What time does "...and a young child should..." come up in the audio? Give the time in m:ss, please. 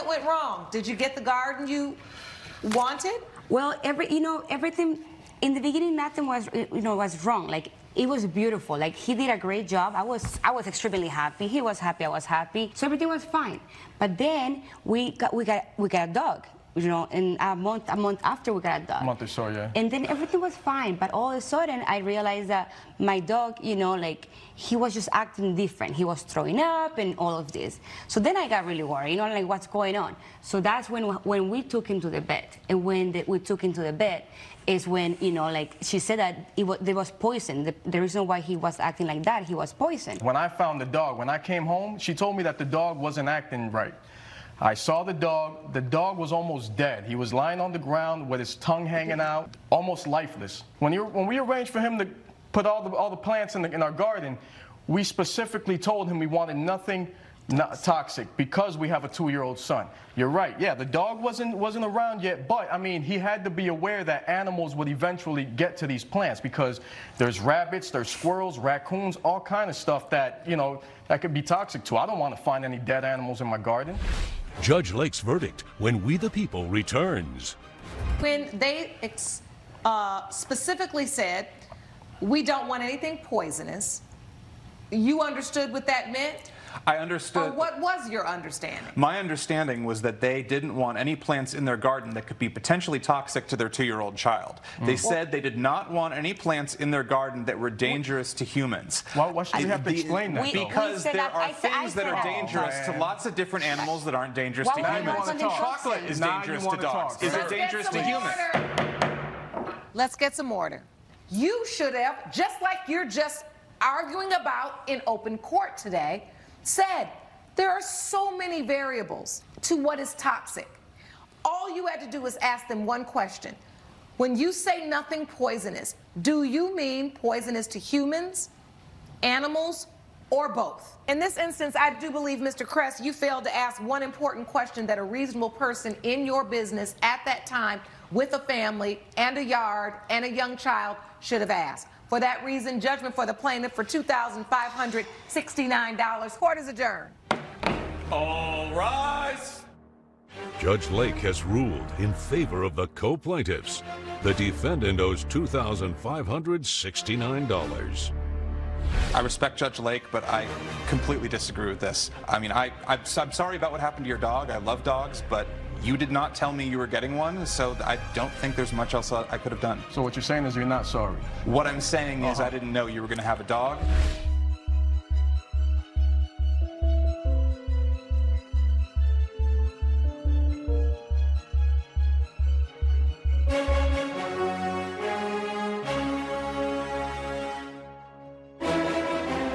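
2:20.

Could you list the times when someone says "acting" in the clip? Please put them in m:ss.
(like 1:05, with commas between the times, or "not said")
0:25, 0:38, 0:43.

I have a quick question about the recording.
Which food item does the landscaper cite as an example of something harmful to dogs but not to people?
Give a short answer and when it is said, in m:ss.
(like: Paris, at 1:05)
Chocolate, at 1:45.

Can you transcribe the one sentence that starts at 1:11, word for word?
I don't want to find any dead animals in my garden.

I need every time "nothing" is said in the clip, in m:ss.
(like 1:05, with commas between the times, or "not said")
0:05, 0:56, 2:04.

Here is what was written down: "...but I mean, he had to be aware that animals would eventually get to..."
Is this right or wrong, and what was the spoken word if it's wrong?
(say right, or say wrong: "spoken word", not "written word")
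right.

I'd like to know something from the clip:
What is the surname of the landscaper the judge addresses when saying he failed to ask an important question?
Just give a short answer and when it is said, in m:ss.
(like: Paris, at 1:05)
Crest, at 2:12.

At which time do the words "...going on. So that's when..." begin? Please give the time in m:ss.
0:29.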